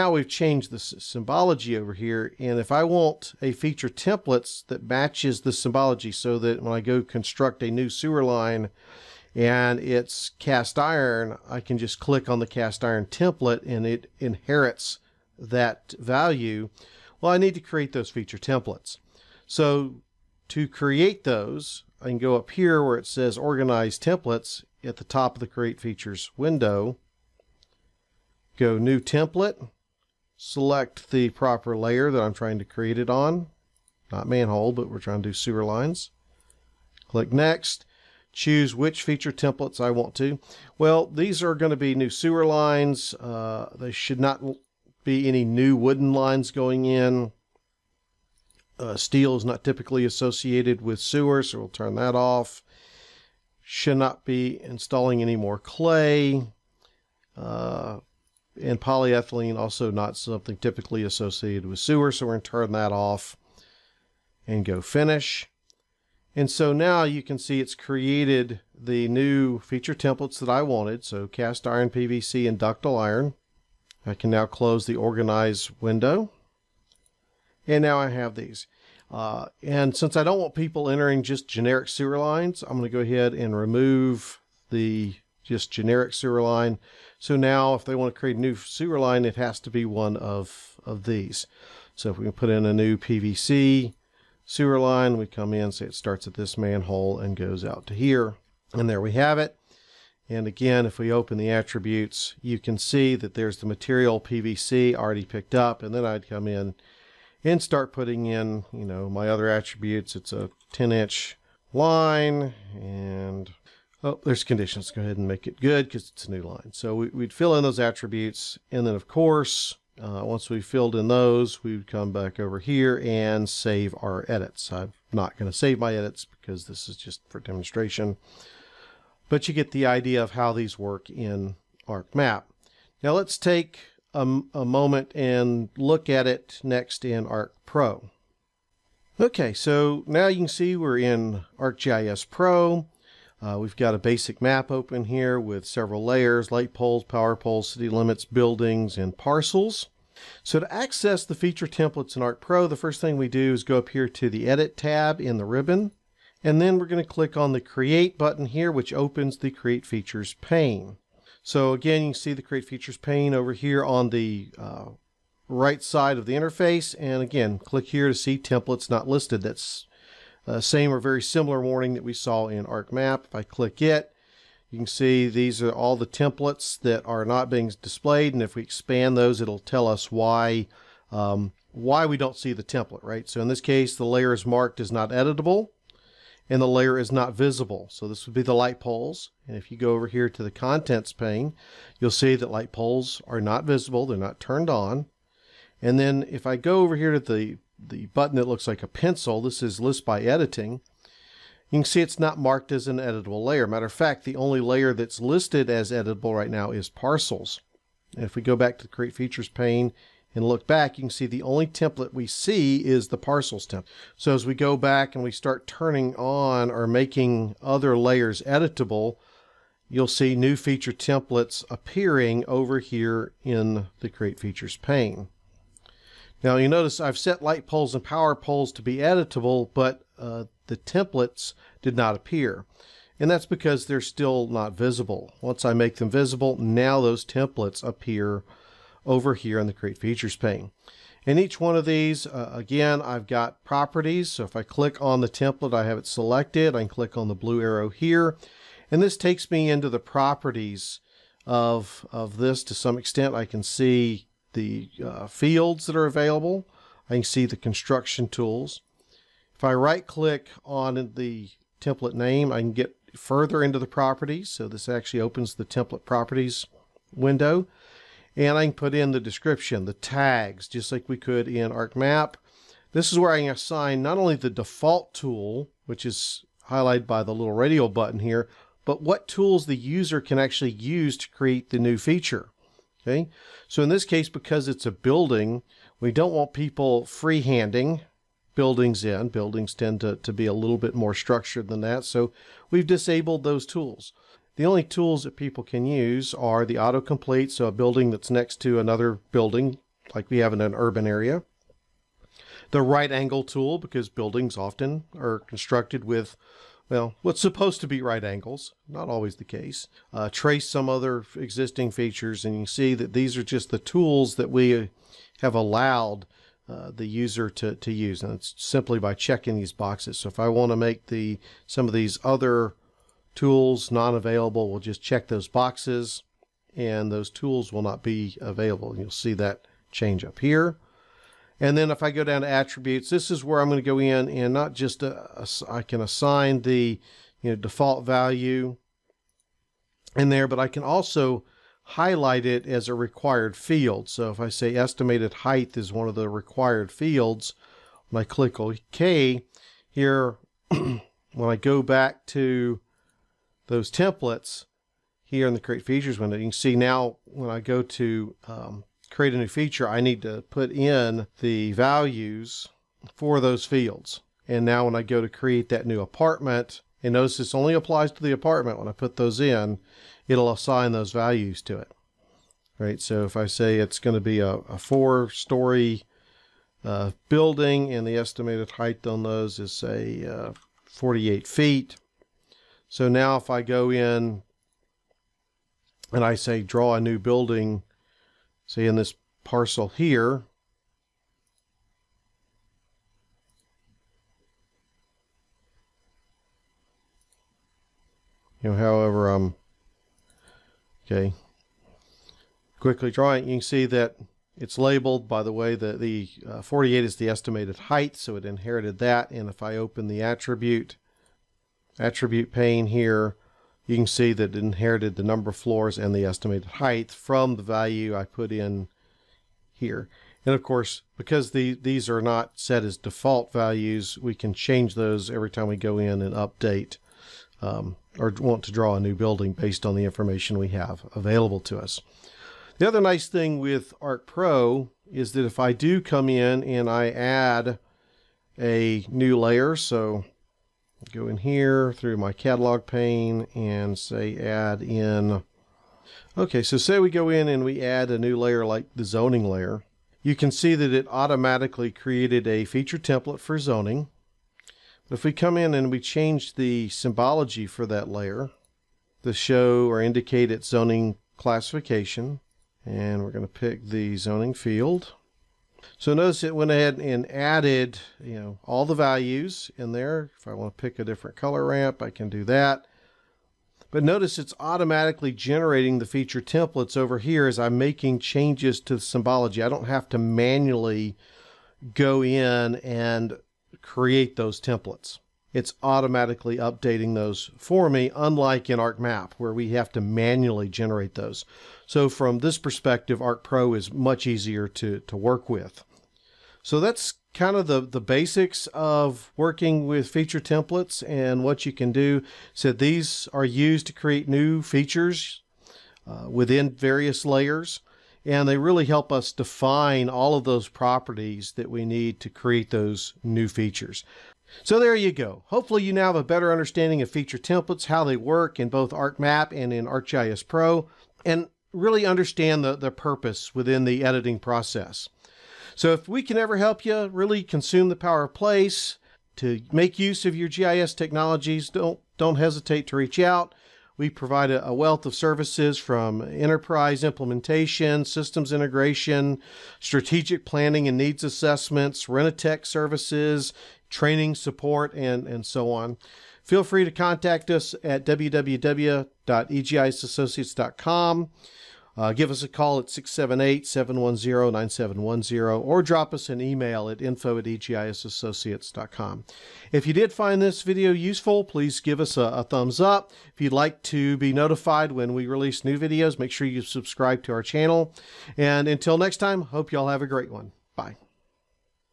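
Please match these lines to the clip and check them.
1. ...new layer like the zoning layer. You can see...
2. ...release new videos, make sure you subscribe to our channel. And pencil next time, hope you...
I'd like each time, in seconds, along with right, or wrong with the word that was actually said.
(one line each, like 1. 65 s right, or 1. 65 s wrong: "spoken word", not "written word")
1. 448 s right
2. 565 s wrong: "until", not "pencil".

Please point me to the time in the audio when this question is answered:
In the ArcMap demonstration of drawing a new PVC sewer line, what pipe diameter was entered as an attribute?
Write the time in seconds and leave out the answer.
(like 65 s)
110 s.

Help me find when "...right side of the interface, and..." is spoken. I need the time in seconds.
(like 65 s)
165 s.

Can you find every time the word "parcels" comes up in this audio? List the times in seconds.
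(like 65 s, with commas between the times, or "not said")
149 s, 206 s, 213 s, 389 s.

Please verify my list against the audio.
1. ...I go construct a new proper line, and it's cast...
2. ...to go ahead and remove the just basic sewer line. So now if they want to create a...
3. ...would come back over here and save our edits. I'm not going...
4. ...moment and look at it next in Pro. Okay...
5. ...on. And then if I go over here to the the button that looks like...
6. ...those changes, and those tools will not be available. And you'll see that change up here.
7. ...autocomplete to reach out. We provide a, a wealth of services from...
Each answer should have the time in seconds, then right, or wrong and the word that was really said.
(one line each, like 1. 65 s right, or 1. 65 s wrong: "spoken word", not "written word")
1. 6 s wrong: "sewer", not "proper"
2. 82 s wrong: "generic", not "basic"
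3. 121 s right
4. 134 s wrong: "ArcPro", not "Pro"
5. 194 s right
6. 325 s wrong: "boxes", not "changes"
7. 532 s wrong: "hesitate", not "autocomplete".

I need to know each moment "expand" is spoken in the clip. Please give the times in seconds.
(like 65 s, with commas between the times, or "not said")
178 s.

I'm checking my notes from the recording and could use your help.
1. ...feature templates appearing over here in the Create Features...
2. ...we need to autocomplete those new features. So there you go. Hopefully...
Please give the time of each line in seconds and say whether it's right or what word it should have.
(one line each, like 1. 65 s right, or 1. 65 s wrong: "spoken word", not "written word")
1. 220 s right
2. 511 s wrong: "create", not "autocomplete".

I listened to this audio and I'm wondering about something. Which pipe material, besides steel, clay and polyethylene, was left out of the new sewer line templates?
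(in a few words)
wooden.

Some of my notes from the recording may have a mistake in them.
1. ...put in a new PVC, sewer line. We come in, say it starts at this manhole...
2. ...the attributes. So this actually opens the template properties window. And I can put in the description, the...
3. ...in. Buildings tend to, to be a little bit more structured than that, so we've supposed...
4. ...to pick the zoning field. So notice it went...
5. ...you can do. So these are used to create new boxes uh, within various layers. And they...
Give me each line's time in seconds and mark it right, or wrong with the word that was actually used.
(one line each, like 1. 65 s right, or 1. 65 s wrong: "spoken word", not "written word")
1. 92 s right
2. 263 s wrong: "properties", not "attributes"
3. 289 s wrong: "disabled", not "supposed"
4. 463 s right
5. 501 s wrong: "features", not "boxes".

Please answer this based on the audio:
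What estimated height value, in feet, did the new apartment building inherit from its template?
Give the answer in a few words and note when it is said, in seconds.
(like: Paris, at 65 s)
48, at 380 s.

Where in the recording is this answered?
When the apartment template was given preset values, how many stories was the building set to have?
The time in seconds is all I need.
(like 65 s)
374 s.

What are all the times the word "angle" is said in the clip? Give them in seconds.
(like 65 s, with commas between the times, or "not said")
303 s, 308 s.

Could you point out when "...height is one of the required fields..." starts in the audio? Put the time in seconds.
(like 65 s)
345 s.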